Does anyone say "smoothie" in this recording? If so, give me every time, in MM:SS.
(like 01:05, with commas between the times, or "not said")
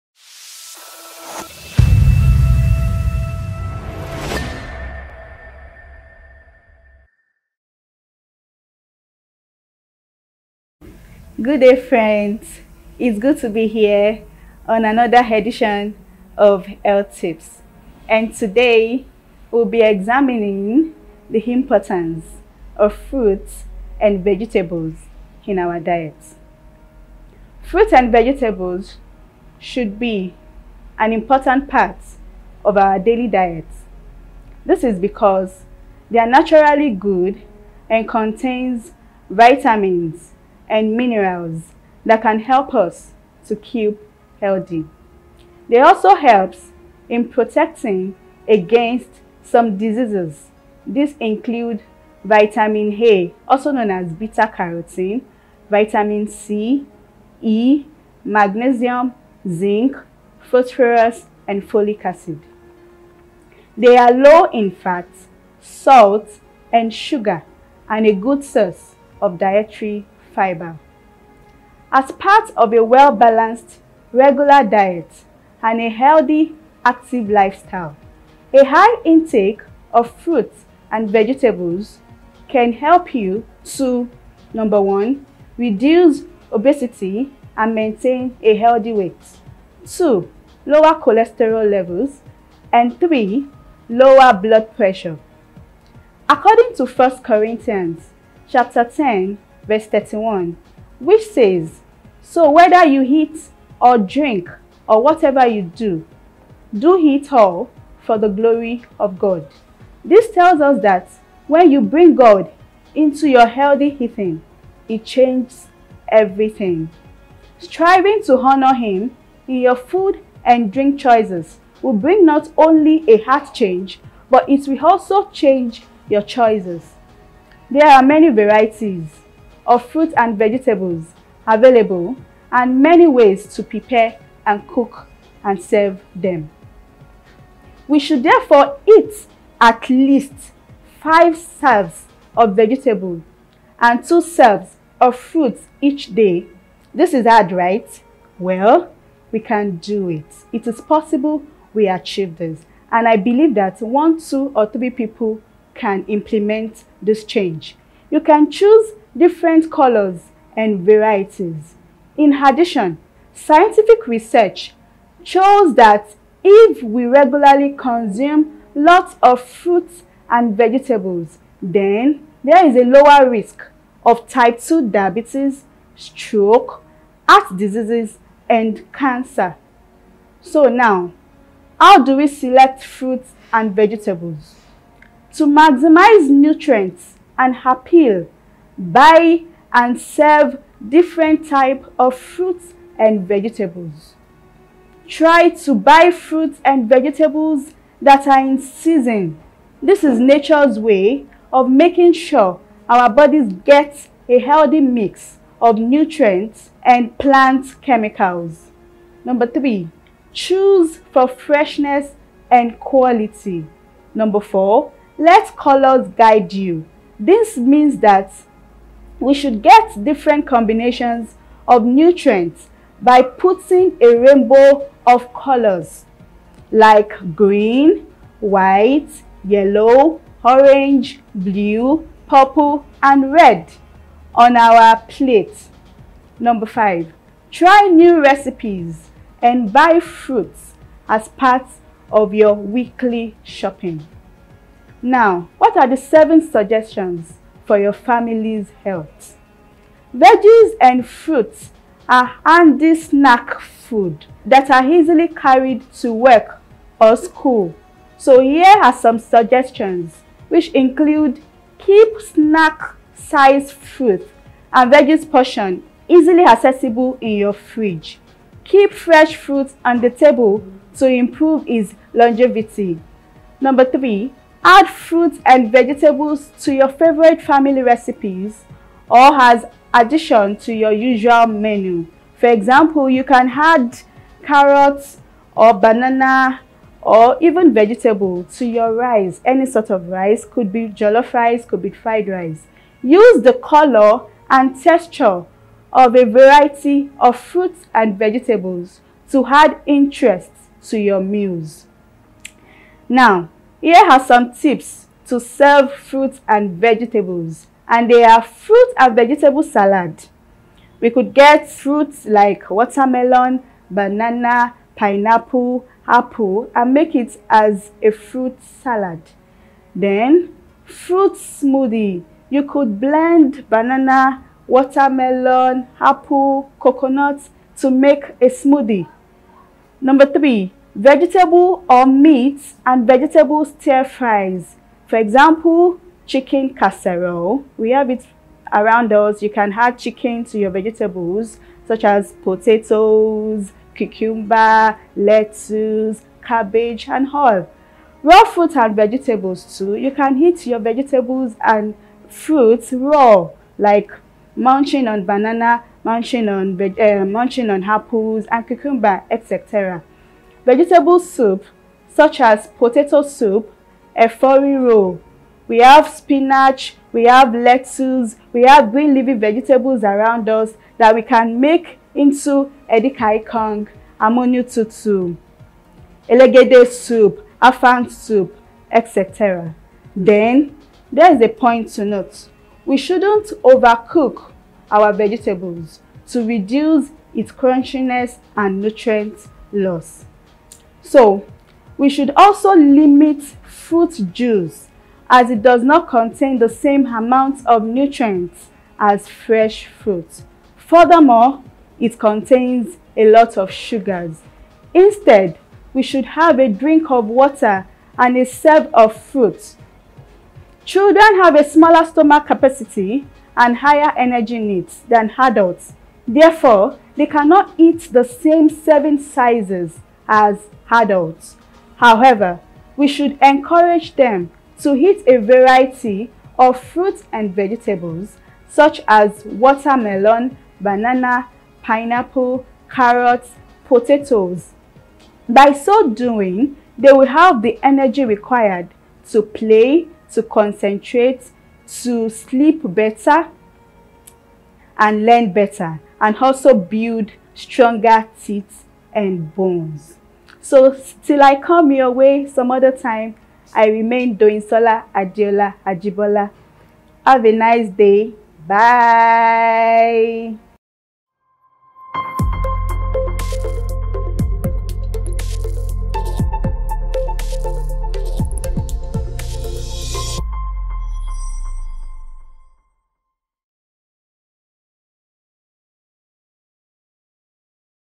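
05:21, 05:28.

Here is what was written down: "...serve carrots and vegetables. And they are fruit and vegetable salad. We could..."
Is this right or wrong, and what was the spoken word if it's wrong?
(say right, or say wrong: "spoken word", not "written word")
wrong: "fruits", not "carrots".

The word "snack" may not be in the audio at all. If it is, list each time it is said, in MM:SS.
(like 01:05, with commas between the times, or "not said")
04:12, 04:22.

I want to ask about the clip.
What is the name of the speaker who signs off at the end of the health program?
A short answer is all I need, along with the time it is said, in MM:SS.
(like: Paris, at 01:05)
Doinsola Adeola Ajibola, at 07:34.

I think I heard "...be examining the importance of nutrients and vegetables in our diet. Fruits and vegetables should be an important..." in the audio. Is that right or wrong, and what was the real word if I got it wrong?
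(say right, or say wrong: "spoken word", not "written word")
wrong: "fruits", not "nutrients".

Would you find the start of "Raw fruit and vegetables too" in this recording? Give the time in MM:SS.
05:48.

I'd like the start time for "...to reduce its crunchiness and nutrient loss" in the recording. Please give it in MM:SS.
06:26.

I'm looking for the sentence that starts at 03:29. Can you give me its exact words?
Number three, choose for freshness and quality.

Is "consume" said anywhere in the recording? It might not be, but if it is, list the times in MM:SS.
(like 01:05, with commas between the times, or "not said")
02:47.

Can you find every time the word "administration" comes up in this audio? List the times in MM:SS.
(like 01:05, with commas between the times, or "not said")
not said.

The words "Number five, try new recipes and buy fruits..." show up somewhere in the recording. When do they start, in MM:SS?
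03:56.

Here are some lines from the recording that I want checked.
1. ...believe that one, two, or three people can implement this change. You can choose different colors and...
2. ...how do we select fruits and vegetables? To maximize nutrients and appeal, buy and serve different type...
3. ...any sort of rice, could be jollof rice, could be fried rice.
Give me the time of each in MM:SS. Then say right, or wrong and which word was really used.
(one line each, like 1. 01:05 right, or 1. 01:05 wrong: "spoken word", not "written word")
1. 02:33 right
2. 03:01 right
3. 04:49 right.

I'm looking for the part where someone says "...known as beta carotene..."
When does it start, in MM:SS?
00:53.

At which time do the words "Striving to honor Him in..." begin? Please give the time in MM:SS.
01:57.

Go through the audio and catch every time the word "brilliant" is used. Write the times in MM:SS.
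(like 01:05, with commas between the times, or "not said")
not said.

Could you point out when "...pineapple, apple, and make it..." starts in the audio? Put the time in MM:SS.
05:14.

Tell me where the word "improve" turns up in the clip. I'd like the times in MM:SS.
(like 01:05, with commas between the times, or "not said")
04:31.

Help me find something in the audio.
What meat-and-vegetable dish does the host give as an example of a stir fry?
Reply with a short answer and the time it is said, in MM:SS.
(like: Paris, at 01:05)
chicken casserole, at 05:36.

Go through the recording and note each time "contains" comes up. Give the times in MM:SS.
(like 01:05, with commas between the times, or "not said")
00:38, 06:36, 06:42.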